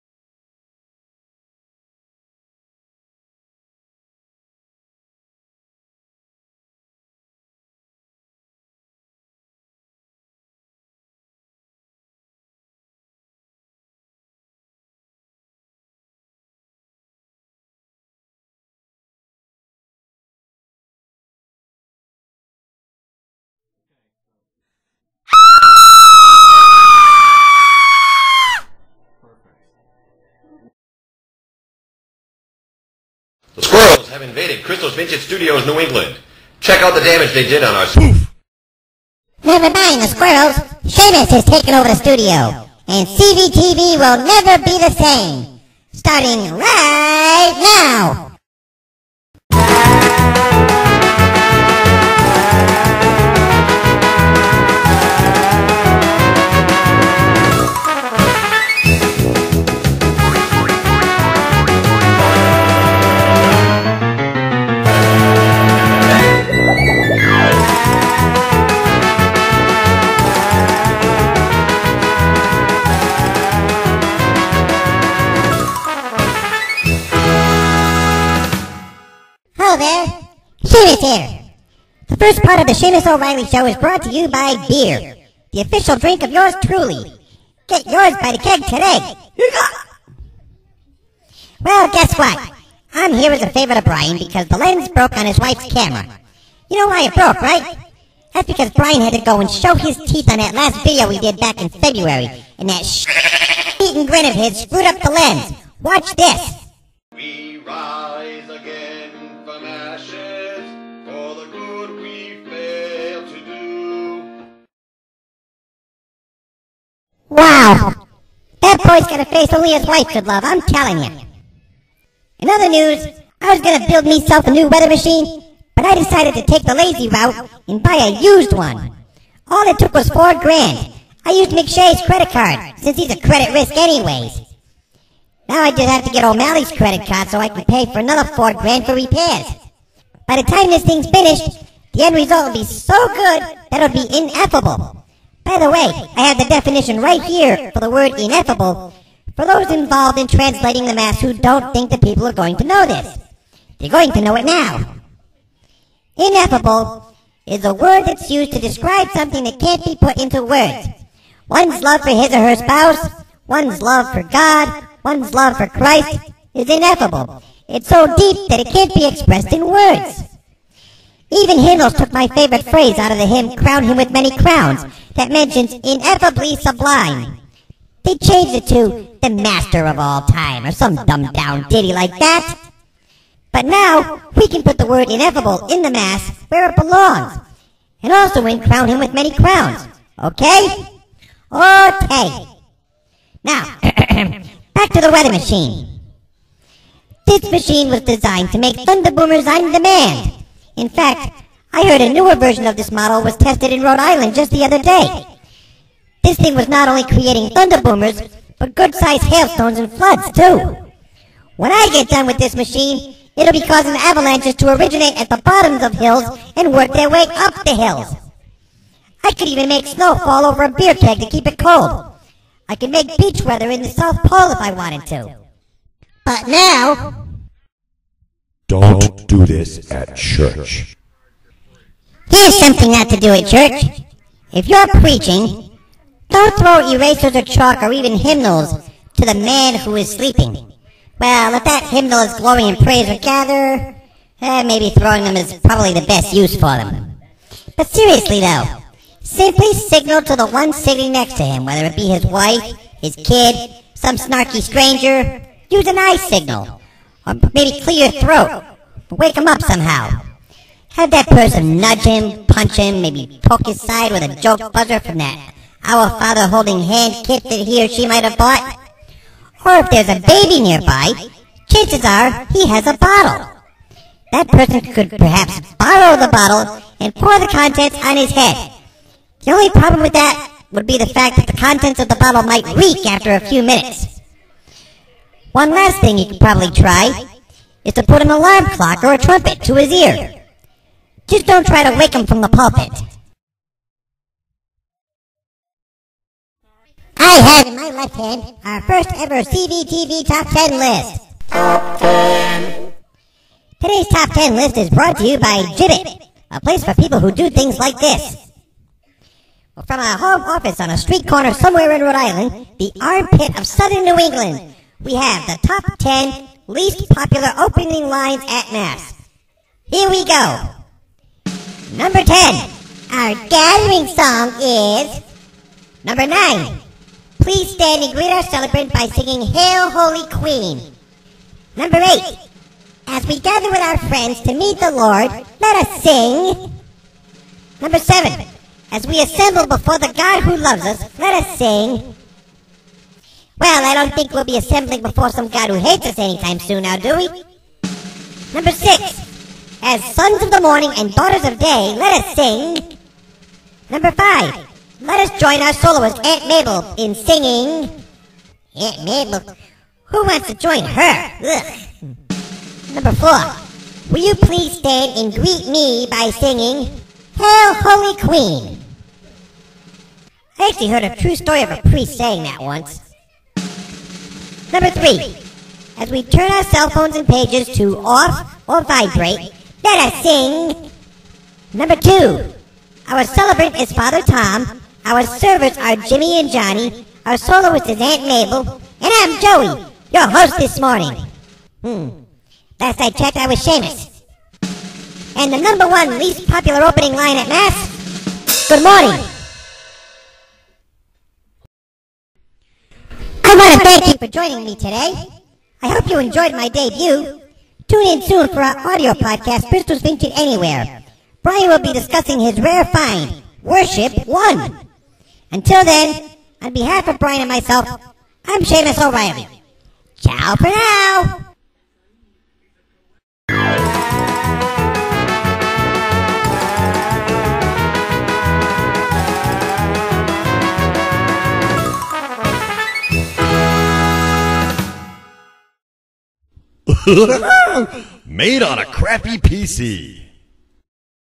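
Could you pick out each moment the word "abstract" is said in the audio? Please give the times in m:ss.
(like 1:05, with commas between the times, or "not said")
not said.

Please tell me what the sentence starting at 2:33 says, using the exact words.
They're going to know it now.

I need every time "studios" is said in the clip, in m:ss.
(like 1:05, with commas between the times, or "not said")
0:35, 0:41.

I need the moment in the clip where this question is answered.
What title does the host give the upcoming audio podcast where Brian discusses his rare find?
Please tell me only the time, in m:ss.
6:49.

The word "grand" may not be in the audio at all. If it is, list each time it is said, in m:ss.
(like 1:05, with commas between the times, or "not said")
2:10, 2:18.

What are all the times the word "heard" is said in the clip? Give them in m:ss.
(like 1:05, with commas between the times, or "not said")
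3:21, 6:10.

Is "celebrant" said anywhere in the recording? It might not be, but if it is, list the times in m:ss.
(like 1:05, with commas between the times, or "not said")
5:28, 6:23.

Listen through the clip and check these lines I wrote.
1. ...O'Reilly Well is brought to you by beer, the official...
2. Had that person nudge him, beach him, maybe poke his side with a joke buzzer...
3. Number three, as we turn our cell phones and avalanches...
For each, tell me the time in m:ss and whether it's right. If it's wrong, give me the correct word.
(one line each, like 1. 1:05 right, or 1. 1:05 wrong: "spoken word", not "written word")
1. 1:23 wrong: "Show", not "Well"
2. 4:20 wrong: "punch", not "beach"
3. 6:14 wrong: "pages", not "avalanches".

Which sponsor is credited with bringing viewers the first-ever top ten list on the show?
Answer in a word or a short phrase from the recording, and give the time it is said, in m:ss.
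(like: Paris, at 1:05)
Gibbet, at 5:05.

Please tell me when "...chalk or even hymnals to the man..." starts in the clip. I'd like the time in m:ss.
3:57.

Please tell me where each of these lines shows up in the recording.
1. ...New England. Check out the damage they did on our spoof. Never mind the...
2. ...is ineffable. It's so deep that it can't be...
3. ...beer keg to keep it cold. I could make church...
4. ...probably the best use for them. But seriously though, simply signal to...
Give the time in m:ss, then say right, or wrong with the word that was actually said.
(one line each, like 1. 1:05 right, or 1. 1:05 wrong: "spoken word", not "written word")
1. 0:35 right
2. 2:46 right
3. 3:40 wrong: "beach", not "church"
4. 4:05 right.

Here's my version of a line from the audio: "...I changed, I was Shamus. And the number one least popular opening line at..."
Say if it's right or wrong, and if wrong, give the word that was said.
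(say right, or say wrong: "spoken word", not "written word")
wrong: "checked", not "changed".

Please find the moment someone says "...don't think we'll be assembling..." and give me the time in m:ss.
5:43.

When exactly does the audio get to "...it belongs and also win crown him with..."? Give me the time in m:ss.
3:06.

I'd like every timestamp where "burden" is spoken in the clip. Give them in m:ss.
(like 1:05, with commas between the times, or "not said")
not said.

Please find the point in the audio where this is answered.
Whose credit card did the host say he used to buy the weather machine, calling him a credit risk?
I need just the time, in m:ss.
2:11.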